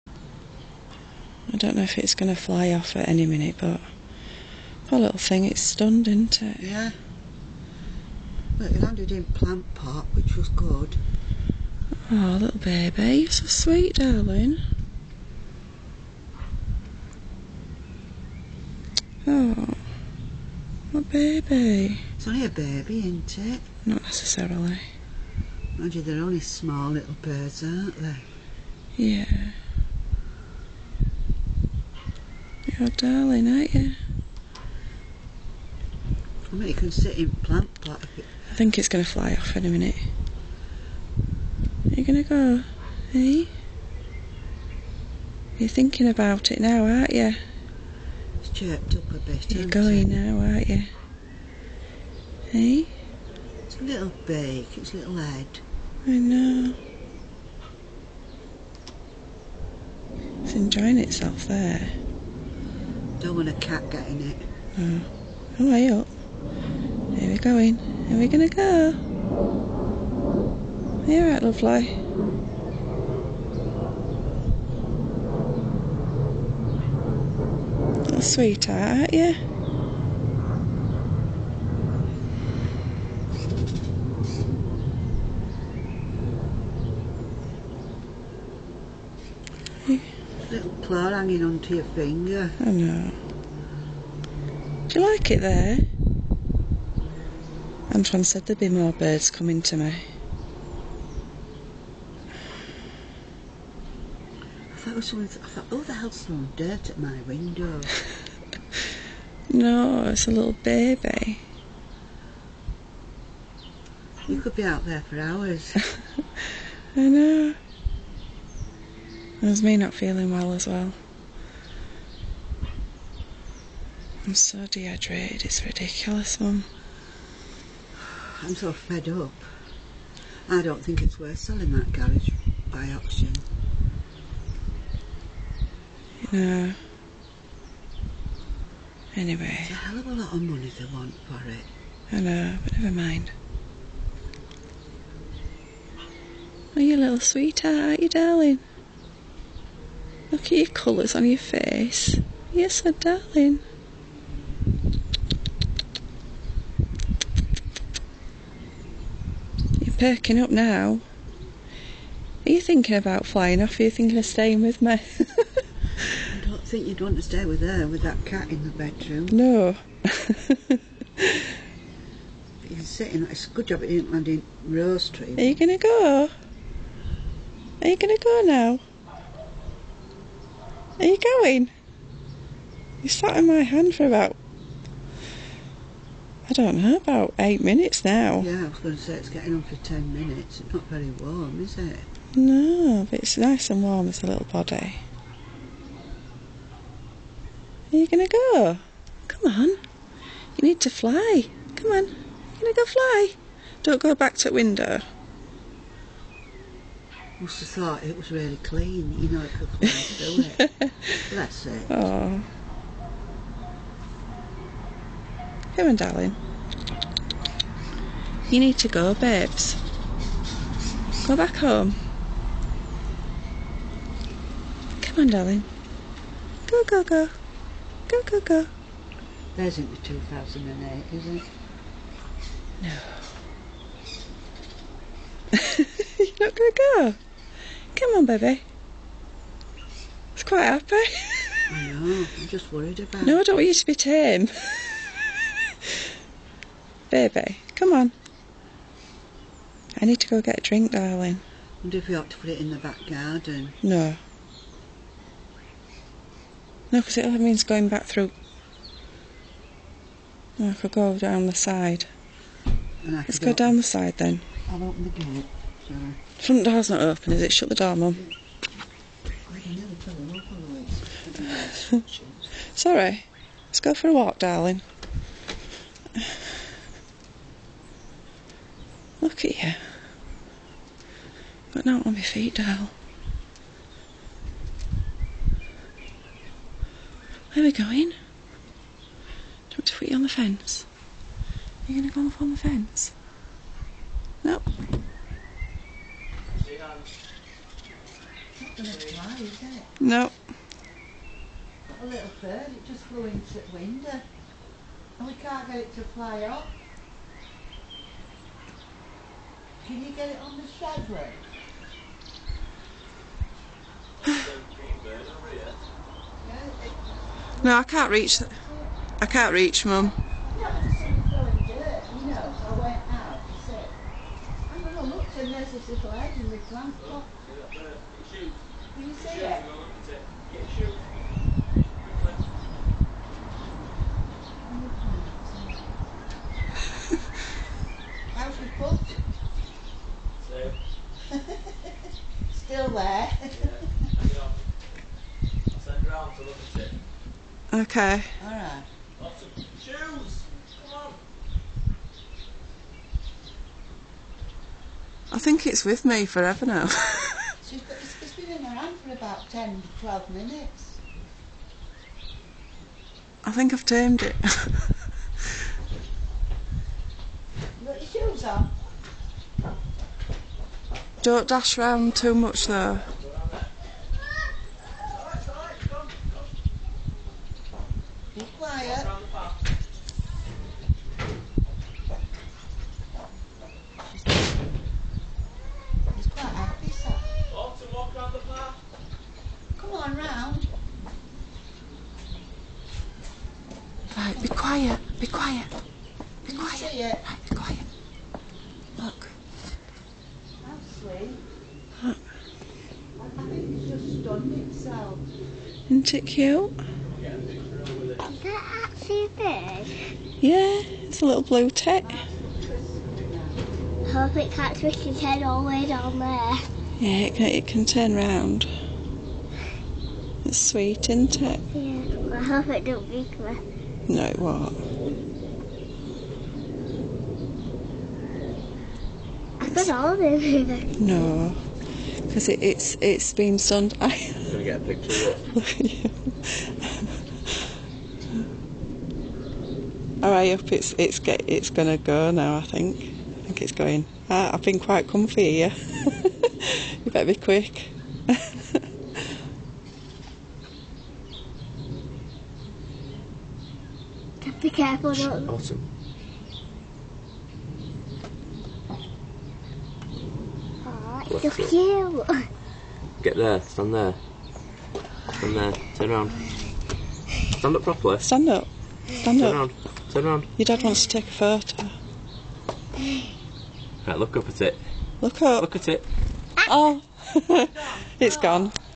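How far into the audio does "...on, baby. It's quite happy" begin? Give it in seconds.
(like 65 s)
238 s.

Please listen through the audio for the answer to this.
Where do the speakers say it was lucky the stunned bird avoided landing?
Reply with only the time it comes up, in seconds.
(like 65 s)
174 s.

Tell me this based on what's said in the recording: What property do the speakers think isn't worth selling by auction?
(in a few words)
garage.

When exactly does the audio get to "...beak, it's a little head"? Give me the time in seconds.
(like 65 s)
54 s.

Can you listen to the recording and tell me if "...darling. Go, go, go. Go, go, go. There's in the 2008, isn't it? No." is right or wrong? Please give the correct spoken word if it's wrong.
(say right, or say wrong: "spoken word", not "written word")
right.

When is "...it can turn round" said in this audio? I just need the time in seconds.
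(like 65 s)
417 s.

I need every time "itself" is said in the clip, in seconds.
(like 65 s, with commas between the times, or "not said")
60 s, 404 s.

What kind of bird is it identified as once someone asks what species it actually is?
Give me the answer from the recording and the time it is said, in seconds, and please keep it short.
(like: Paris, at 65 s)
blue tit, at 411 s.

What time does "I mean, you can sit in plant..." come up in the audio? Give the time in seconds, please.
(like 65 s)
36 s.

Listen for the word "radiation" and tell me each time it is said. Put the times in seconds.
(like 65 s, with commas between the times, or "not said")
not said.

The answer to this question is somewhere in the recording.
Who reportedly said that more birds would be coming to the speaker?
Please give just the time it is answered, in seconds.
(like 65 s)
97 s.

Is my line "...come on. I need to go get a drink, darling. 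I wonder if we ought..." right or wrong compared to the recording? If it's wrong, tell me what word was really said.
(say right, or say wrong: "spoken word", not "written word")
right.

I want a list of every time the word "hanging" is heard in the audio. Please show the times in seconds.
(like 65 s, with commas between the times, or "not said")
91 s.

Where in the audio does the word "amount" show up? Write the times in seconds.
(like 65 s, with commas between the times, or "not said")
not said.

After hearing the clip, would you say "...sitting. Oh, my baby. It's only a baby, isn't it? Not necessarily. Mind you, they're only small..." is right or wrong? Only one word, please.
wrong.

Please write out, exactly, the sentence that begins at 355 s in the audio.
think it's with me forever now.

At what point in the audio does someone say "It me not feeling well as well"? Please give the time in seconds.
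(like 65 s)
119 s.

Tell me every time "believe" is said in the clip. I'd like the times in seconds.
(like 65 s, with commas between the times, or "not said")
not said.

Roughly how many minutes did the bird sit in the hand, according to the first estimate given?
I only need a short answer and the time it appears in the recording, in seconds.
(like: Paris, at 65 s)
8, at 187 s.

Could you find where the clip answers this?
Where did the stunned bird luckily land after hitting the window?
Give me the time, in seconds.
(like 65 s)
9 s.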